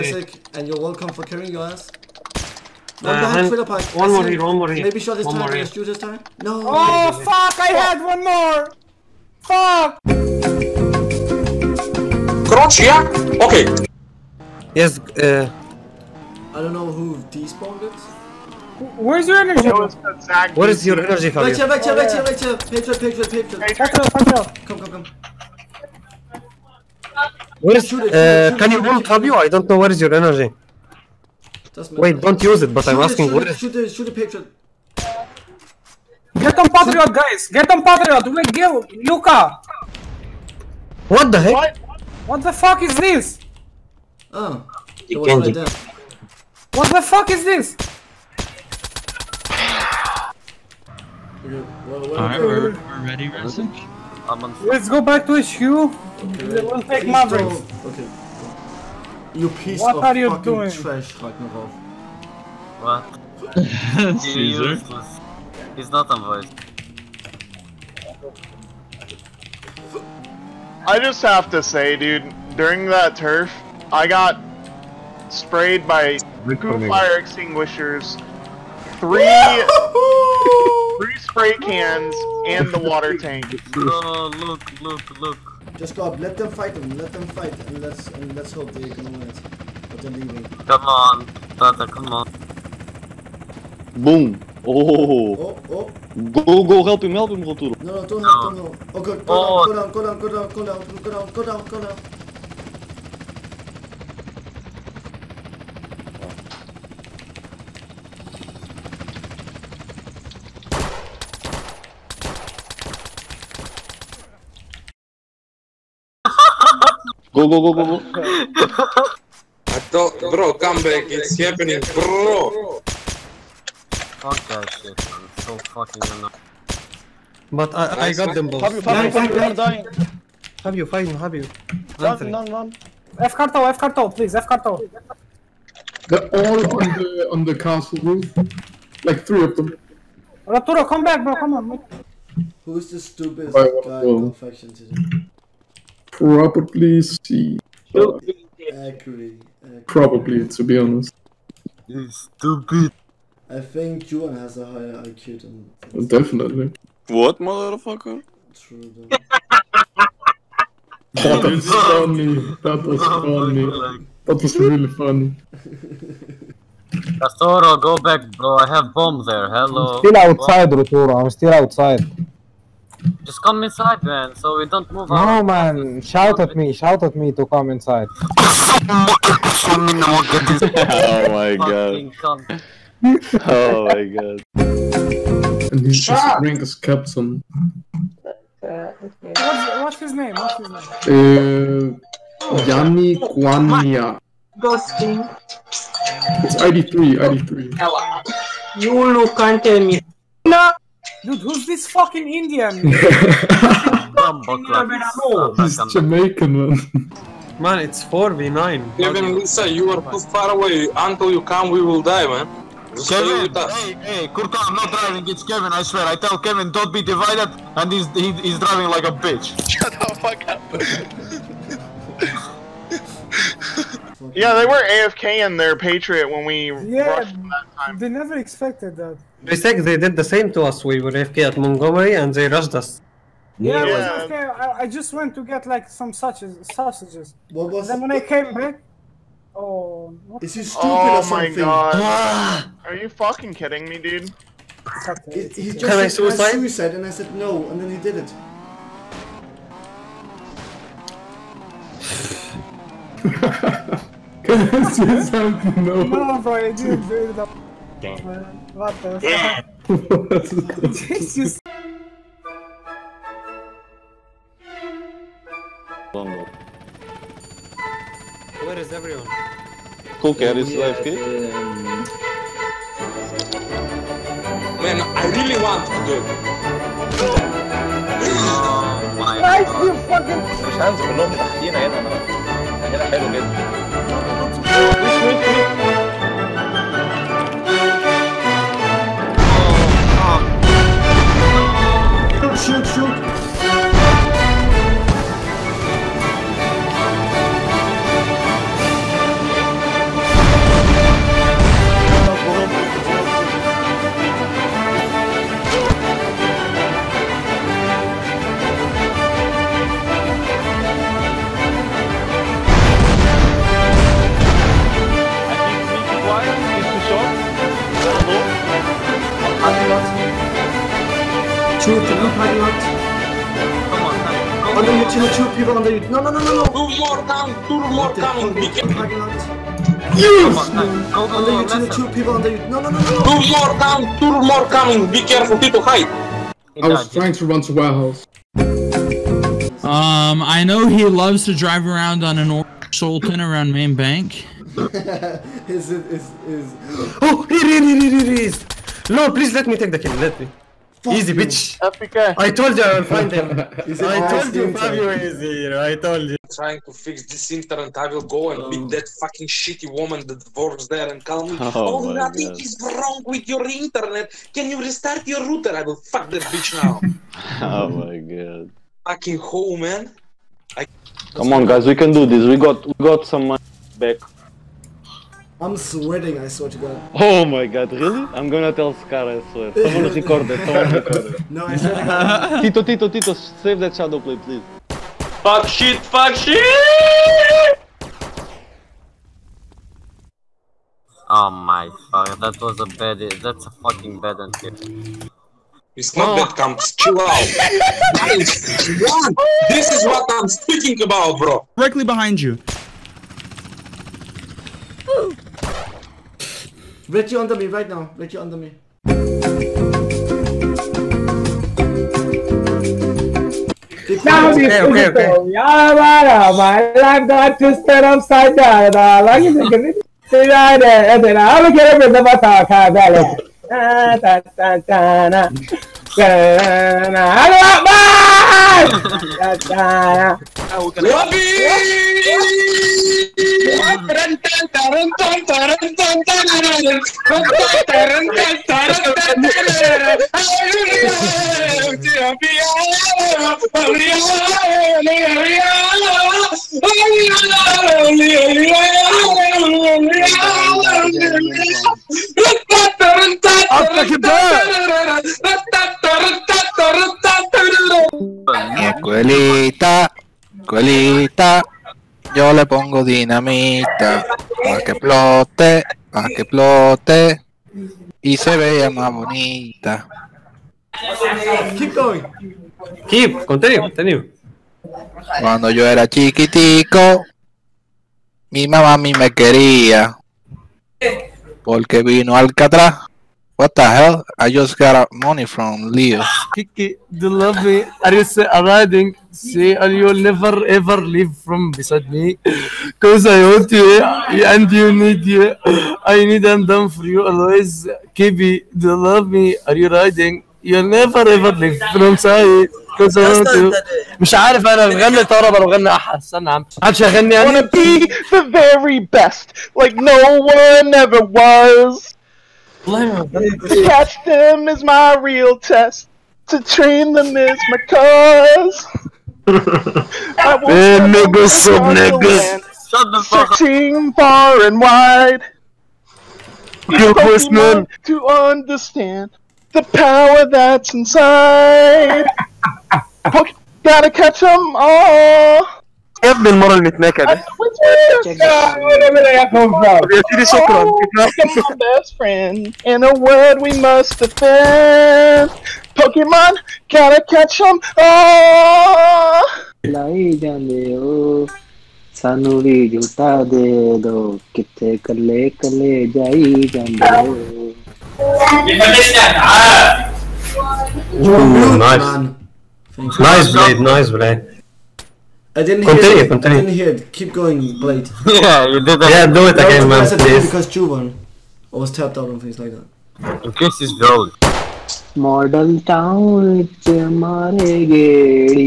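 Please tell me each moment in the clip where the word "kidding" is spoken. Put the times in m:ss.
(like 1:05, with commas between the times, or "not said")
4:03.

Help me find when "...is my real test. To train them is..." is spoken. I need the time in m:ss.
8:34.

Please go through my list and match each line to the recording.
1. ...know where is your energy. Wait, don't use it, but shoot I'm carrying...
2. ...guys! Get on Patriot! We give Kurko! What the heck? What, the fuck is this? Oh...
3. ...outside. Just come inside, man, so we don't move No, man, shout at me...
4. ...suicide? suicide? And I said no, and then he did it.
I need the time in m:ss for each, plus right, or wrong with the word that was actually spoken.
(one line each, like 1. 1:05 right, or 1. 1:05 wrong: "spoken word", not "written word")
1. 0:29 wrong: "asking", not "carrying"
2. 0:37 wrong: "Luca", not "Kurko"
3. 2:51 right
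4. 4:06 right.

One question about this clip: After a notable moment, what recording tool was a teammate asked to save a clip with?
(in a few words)
ShadowPlay.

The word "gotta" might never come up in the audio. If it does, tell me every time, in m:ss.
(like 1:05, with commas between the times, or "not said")
8:53, 9:06.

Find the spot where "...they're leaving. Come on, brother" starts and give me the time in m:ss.
1:30.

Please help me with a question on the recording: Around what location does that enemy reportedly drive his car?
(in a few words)
main bank.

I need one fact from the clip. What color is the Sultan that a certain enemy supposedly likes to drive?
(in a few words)
orange.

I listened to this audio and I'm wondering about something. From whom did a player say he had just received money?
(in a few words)
Leo.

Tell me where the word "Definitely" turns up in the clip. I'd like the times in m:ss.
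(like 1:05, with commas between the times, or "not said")
2:36.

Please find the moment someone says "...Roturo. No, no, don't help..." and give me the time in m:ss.
1:37.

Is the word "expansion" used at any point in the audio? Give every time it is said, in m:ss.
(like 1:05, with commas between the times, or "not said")
not said.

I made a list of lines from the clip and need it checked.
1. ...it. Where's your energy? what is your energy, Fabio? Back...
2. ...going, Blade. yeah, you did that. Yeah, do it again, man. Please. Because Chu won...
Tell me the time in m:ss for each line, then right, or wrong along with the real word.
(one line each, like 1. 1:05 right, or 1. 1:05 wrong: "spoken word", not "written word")
1. 0:17 right
2. 9:27 right.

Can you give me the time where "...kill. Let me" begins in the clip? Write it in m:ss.
5:49.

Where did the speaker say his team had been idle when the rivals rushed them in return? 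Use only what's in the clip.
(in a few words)
Montgomery.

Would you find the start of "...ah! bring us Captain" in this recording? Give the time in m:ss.
3:06.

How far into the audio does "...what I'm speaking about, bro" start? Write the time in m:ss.
6:40.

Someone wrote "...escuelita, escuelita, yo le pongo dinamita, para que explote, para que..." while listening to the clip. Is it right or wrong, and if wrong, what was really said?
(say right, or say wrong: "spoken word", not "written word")
right.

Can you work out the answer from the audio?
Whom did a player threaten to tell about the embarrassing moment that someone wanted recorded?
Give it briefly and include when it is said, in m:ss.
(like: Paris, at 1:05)
Scar, at 6:18.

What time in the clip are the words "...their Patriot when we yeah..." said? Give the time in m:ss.
3:45.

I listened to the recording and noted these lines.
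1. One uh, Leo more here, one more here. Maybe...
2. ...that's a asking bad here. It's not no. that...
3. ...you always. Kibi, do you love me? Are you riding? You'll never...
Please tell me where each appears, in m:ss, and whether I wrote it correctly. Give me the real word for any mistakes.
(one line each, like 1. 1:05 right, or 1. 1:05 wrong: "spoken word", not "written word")
1. 0:03 wrong: "One", not "Leo"
2. 6:33 wrong: "fucking", not "asking"
3. 8:17 right.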